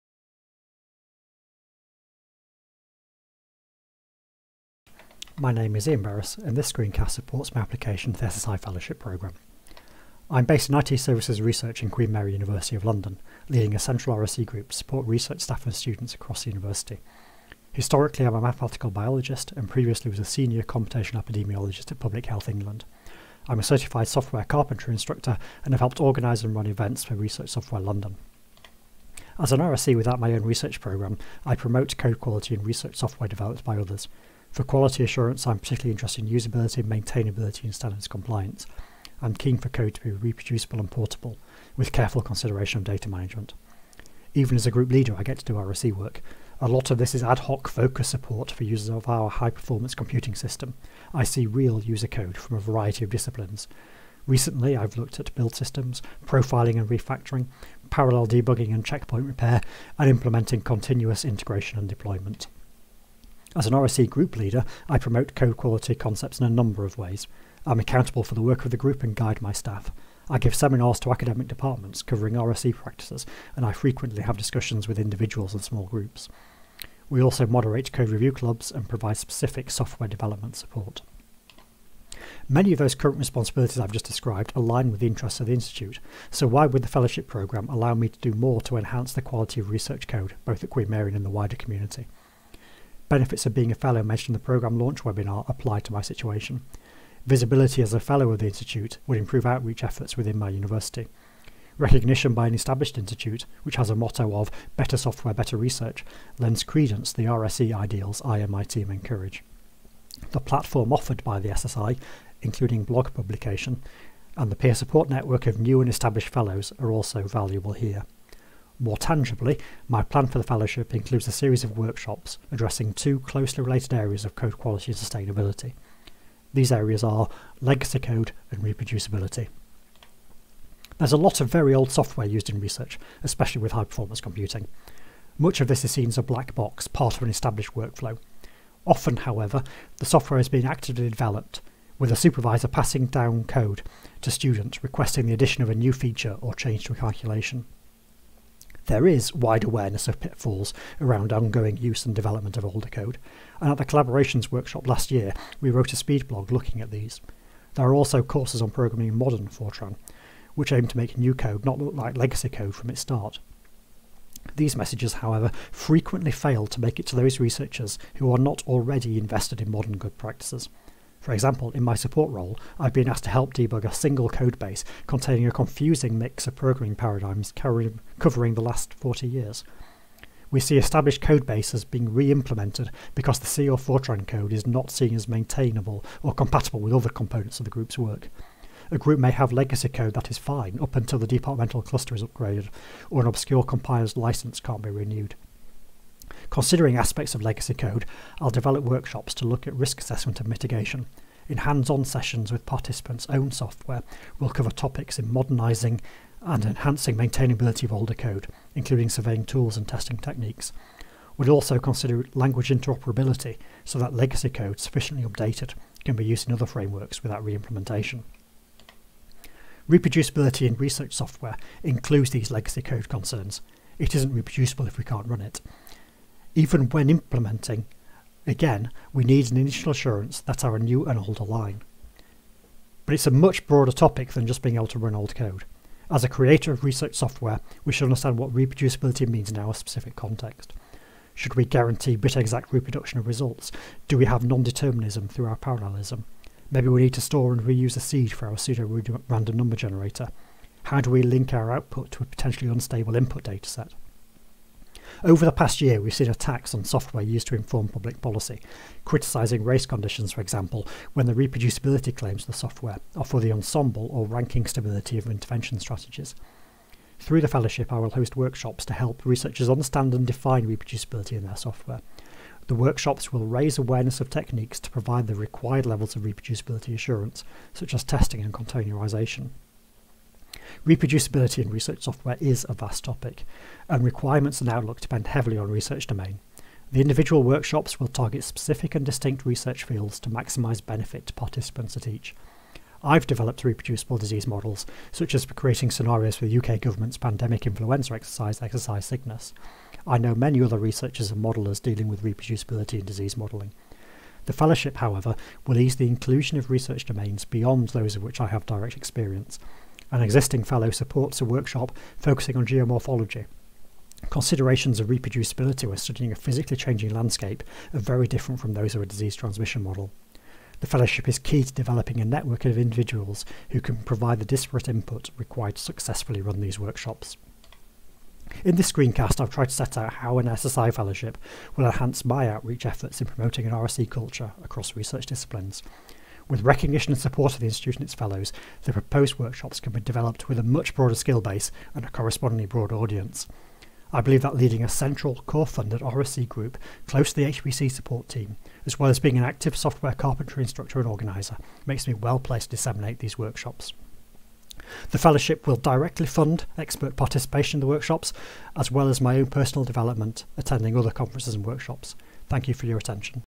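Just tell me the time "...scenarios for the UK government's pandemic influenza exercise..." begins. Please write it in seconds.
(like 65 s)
295 s.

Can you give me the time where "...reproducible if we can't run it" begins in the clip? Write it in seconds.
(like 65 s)
224 s.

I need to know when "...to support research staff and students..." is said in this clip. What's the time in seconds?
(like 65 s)
14 s.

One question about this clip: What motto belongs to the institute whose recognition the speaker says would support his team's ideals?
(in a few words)
better software, better research.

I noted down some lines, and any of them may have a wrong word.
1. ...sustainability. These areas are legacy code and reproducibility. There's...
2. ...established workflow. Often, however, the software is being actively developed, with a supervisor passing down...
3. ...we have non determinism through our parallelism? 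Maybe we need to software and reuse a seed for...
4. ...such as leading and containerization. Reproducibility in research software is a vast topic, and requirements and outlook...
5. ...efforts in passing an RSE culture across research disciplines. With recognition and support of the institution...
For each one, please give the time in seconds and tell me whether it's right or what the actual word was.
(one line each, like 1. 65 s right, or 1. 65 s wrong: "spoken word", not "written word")
1. 124 s right
2. 137 s right
3. 244 s wrong: "store", not "software"
4. 277 s wrong: "testing", not "leading"
5. 332 s wrong: "promoting", not "passing".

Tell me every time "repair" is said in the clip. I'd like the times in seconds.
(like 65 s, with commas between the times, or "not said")
59 s.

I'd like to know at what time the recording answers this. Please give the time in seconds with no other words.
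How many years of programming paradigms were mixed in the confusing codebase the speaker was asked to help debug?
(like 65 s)
178 s.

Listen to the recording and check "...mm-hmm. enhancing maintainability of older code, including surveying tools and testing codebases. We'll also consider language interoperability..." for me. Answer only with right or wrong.
wrong.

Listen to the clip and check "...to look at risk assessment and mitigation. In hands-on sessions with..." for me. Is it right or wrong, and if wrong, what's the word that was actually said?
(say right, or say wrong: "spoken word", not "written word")
right.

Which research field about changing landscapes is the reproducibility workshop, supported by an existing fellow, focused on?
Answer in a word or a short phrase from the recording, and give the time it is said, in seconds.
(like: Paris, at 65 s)
geomorphology, at 312 s.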